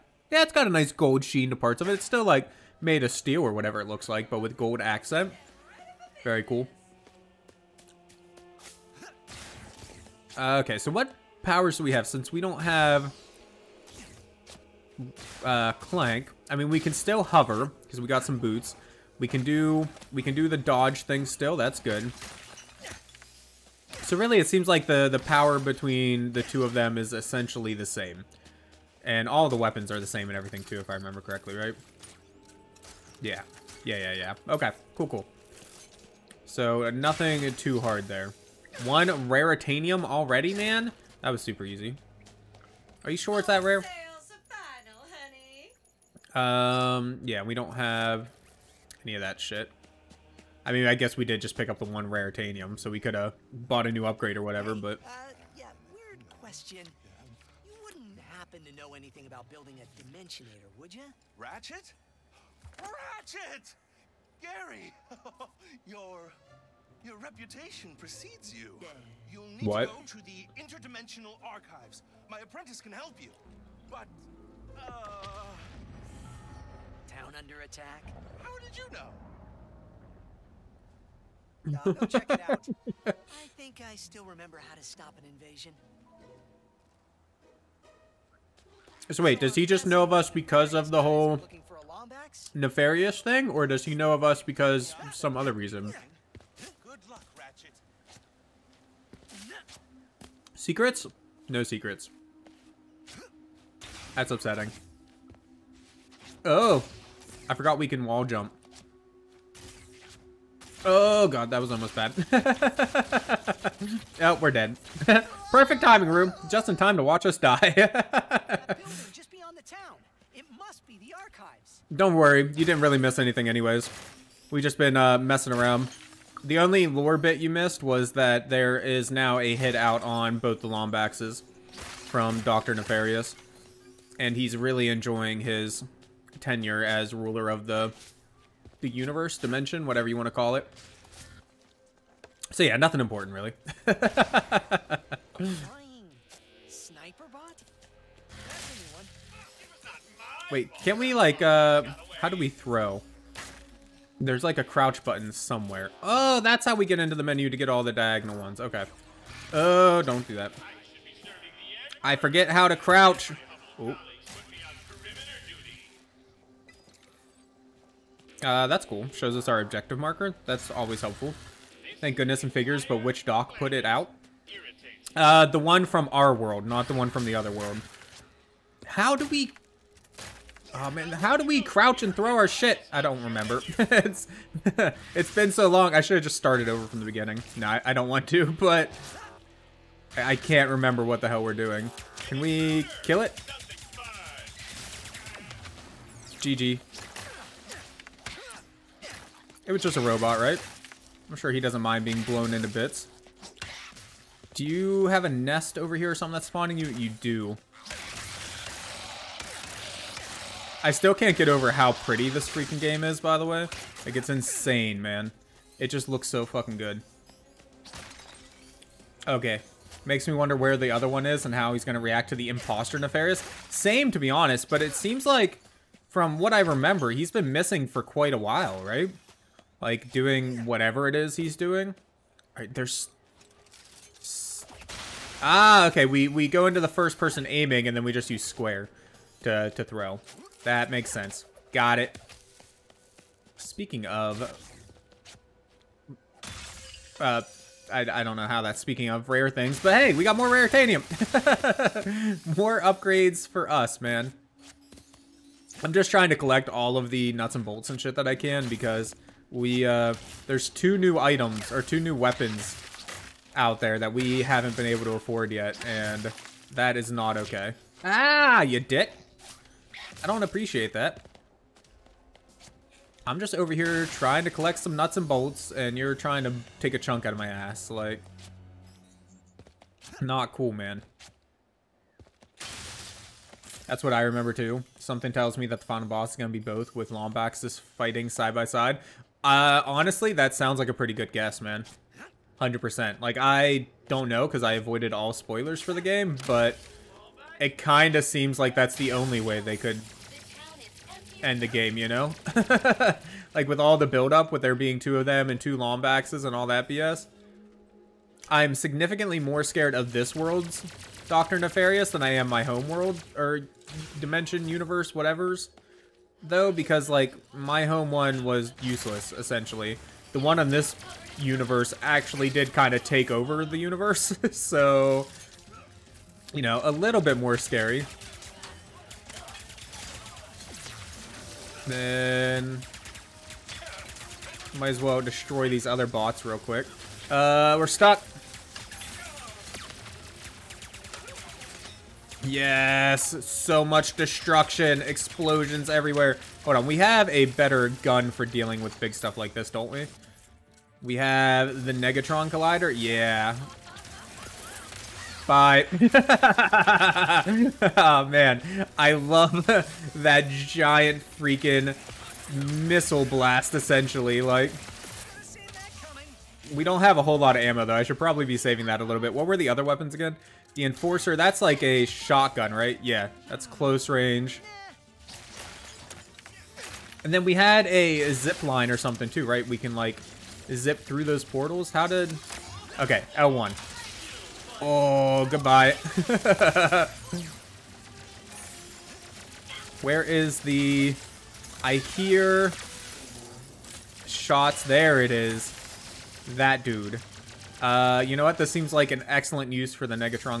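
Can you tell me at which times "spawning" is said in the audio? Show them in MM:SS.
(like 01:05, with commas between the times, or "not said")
03:26.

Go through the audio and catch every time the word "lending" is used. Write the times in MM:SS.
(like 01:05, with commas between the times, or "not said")
not said.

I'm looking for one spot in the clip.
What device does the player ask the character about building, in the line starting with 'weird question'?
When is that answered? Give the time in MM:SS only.
01:00.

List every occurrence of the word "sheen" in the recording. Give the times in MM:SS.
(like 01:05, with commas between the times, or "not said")
00:01.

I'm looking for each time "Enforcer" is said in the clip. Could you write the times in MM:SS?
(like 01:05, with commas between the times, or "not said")
06:10.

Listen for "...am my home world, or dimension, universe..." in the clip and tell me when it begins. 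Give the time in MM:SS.
05:12.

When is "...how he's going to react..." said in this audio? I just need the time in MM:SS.
03:41.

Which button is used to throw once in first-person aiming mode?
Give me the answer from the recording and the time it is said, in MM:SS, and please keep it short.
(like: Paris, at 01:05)
square, at 03:58.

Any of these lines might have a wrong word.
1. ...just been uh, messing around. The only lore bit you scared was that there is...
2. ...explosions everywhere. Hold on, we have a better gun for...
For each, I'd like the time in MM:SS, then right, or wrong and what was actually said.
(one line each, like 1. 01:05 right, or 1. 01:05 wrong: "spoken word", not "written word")
1. 02:04 wrong: "missed", not "scared"
2. 05:45 right.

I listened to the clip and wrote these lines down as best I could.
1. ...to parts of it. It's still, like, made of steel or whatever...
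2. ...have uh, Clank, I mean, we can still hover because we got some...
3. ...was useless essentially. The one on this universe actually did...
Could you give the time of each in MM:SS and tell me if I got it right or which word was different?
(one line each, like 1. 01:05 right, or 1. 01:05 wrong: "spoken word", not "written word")
1. 00:01 right
2. 00:12 right
3. 05:18 right.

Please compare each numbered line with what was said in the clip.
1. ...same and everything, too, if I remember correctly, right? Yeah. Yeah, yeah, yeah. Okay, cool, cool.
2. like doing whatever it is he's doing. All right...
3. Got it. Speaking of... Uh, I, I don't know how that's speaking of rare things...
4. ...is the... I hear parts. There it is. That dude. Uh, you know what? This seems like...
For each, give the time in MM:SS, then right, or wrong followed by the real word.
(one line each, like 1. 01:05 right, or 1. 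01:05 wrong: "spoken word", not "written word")
1. 00:30 right
2. 03:49 right
3. 04:01 right
4. 06:30 wrong: "shots", not "parts".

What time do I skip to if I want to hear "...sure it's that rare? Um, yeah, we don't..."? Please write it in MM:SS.
00:43.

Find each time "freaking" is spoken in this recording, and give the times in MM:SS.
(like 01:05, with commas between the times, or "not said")
03:32, 06:01.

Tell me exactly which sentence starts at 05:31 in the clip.
Then might as well destroy these other bots real quick.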